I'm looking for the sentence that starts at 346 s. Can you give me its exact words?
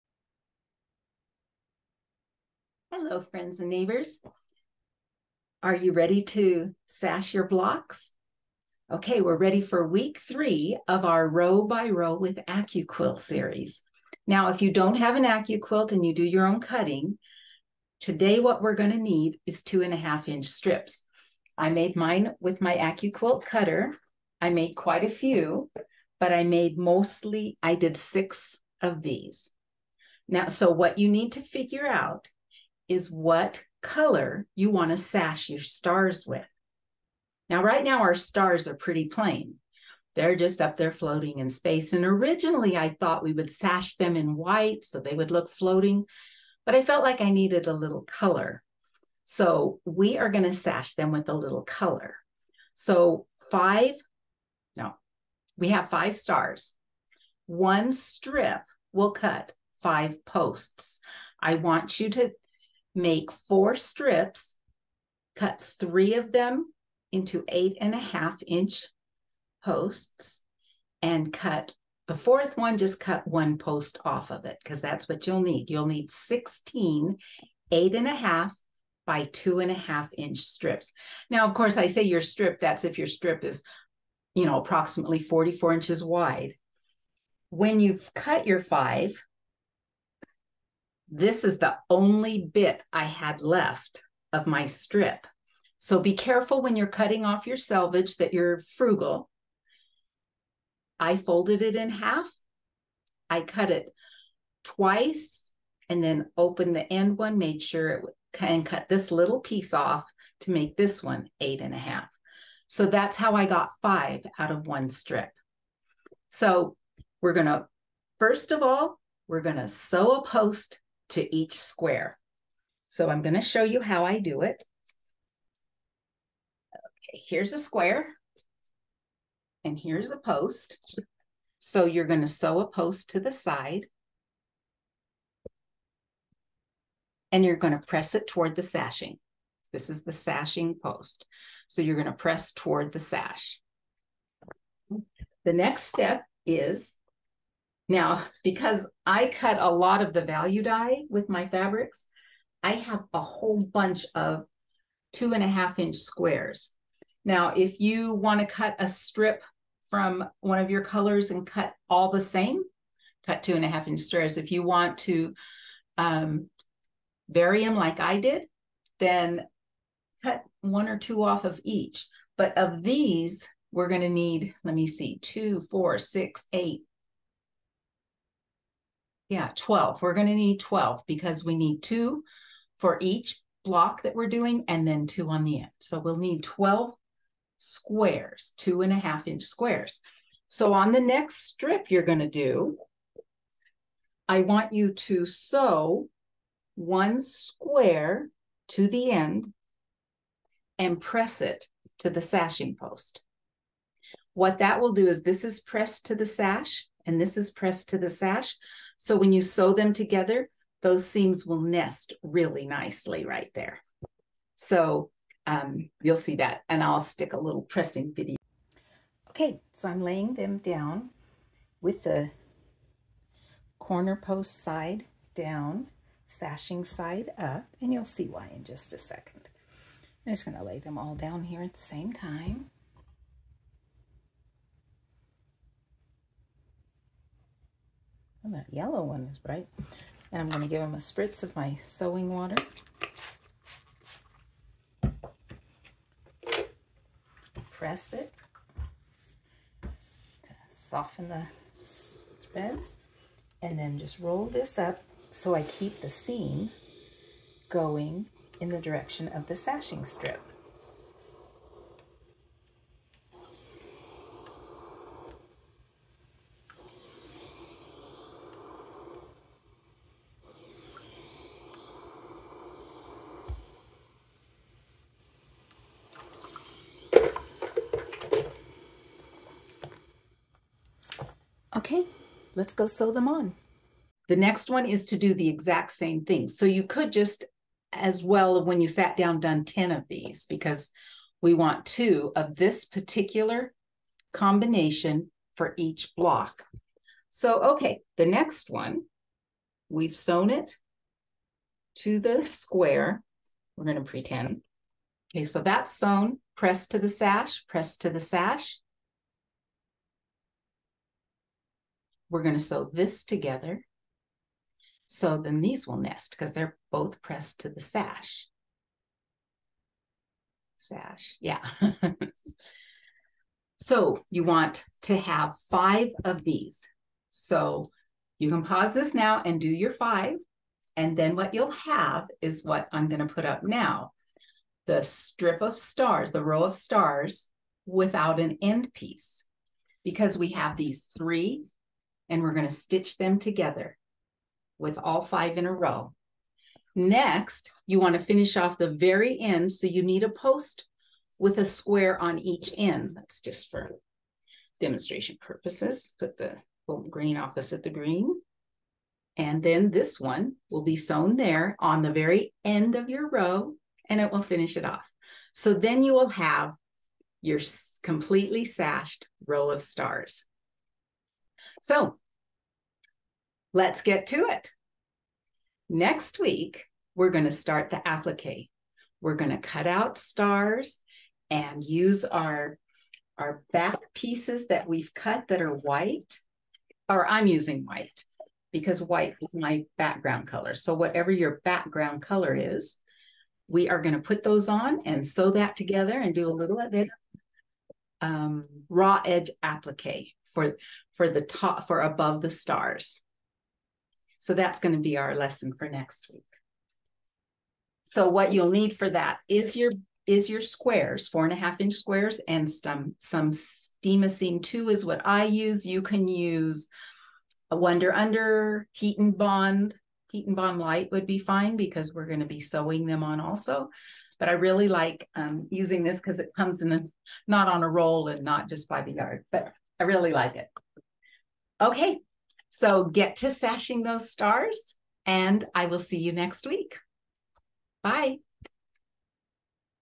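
Next, you want to finish off the very end, so you need a post with a square on each end.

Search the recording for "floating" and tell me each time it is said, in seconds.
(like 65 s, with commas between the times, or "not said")
40 s, 45 s.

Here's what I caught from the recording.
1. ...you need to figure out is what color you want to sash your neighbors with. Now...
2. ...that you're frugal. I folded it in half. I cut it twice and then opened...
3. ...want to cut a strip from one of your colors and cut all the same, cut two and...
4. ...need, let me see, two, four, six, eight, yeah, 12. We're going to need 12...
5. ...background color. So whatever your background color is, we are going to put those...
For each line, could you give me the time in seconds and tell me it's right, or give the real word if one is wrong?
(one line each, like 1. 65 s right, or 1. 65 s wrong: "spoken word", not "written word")
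1. 30 s wrong: "stars", not "neighbors"
2. 98 s right
3. 158 s right
4. 174 s right
5. 389 s right.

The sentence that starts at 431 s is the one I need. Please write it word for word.
Okay, so get to sashing those stars, and I will see you next week.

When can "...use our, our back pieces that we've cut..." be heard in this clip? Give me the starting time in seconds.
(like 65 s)
381 s.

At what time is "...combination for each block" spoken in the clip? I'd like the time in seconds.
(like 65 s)
294 s.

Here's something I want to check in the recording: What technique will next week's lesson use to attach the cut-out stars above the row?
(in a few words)
raw edge applique.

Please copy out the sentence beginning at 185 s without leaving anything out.
So we'll need 12 squares, two and a half inch squares.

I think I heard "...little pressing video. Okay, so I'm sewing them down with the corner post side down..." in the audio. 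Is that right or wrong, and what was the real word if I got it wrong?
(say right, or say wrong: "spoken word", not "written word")
wrong: "laying", not "sewing".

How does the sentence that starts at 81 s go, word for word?
Now, of course, I say your strip, that's if your strip is, you know, approximately 44 inches wide.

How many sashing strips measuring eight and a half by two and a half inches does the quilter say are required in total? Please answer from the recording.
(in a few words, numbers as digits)
16.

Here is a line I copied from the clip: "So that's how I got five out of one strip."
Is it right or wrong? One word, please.
right.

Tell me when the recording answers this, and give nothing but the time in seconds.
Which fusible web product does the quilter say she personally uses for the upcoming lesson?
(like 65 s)
413 s.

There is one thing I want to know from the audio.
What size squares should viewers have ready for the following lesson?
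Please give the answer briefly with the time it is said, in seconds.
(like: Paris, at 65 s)
4 1/2 inch, at 411 s.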